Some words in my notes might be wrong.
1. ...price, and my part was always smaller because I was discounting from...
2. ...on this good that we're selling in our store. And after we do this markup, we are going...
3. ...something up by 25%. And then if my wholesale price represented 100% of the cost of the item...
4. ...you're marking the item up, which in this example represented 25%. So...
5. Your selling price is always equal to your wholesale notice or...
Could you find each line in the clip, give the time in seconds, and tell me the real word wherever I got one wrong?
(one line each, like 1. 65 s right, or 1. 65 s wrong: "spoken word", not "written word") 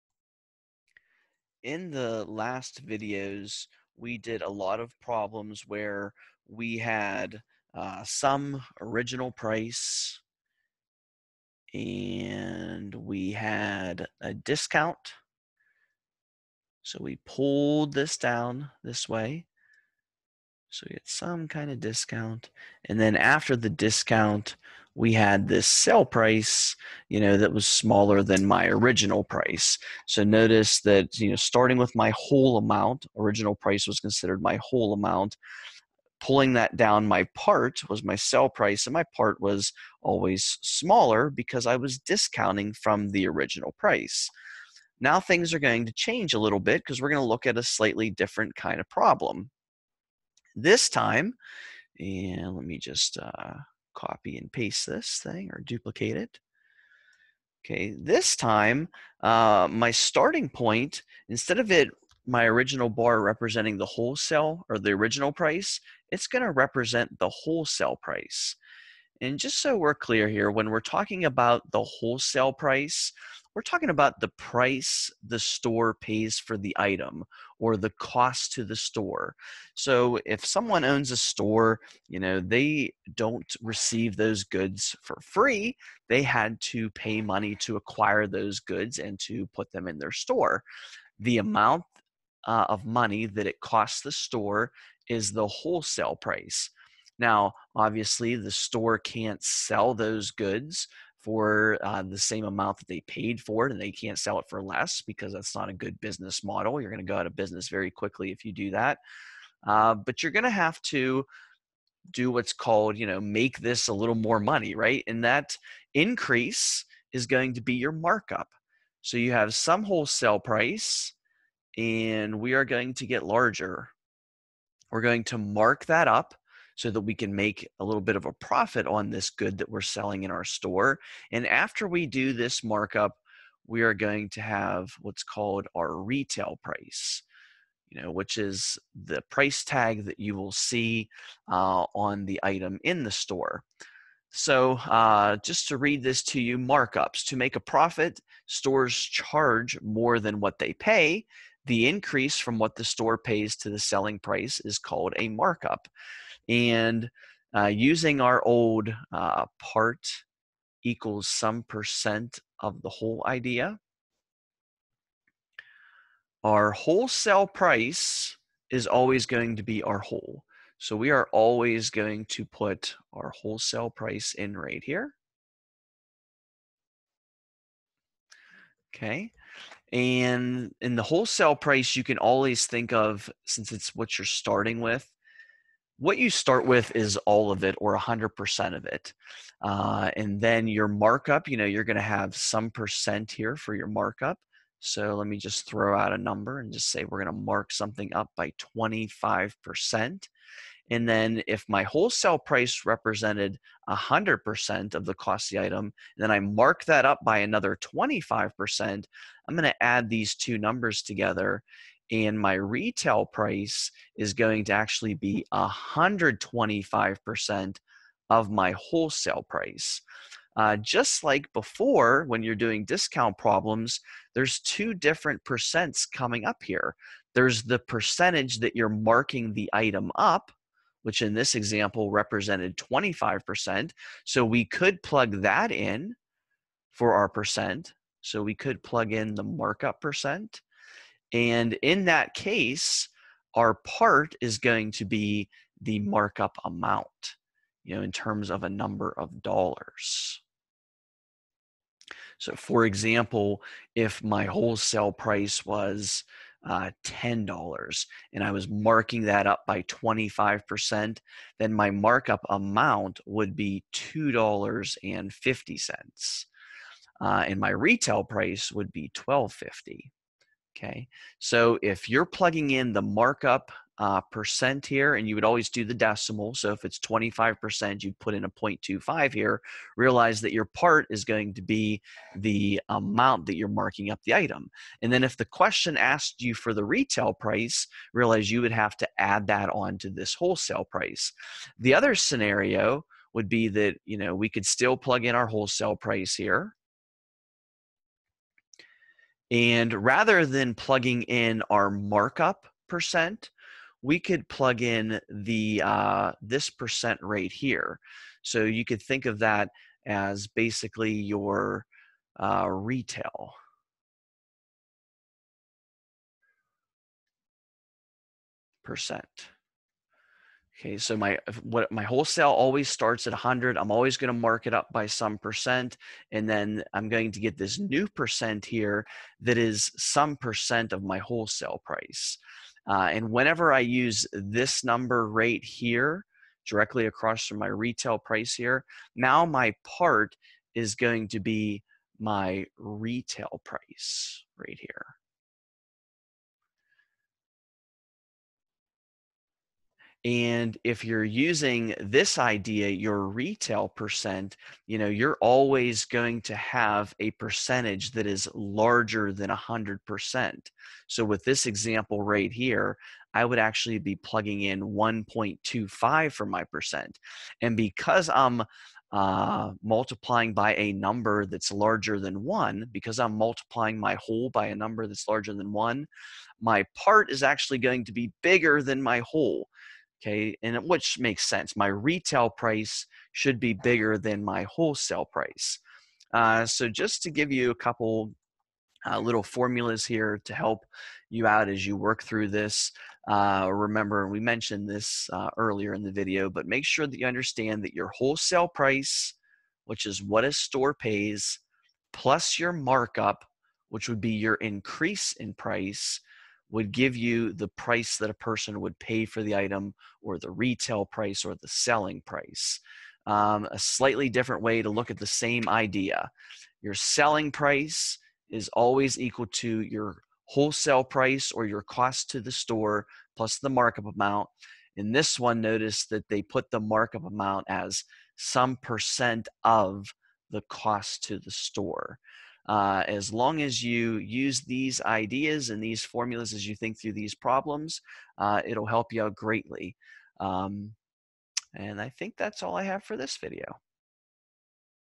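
1. 38 s right
2. 128 s right
3. 197 s right
4. 228 s right
5. 416 s wrong: "price", not "notice".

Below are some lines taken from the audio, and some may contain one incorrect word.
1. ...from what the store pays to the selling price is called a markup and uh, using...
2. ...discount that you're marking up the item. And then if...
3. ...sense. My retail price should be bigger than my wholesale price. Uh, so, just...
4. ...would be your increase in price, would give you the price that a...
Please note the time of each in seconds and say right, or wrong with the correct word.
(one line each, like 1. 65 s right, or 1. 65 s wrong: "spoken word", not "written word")
1. 152 s right
2. 282 s wrong: "amount", not "discount"
3. 381 s right
4. 404 s right.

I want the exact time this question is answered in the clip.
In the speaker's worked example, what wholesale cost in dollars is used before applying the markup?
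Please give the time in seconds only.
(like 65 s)
257 s.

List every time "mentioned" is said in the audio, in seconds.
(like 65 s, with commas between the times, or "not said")
394 s.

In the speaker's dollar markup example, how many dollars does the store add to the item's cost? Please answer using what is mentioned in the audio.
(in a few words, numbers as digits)
$2.50.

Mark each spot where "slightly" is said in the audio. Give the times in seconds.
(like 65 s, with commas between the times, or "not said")
47 s, 413 s.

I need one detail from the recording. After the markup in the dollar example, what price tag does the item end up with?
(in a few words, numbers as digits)
$12.50.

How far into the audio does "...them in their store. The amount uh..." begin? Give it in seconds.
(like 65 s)
89 s.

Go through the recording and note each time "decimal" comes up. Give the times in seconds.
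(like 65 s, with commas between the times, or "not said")
275 s.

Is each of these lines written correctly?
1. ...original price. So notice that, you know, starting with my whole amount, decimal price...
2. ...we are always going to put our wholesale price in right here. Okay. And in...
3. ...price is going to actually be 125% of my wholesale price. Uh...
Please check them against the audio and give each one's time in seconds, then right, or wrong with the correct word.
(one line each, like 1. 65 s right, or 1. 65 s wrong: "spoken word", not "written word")
1. 28 s wrong: "original", not "decimal"
2. 170 s right
3. 213 s right.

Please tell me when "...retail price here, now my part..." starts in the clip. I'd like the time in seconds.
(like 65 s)
337 s.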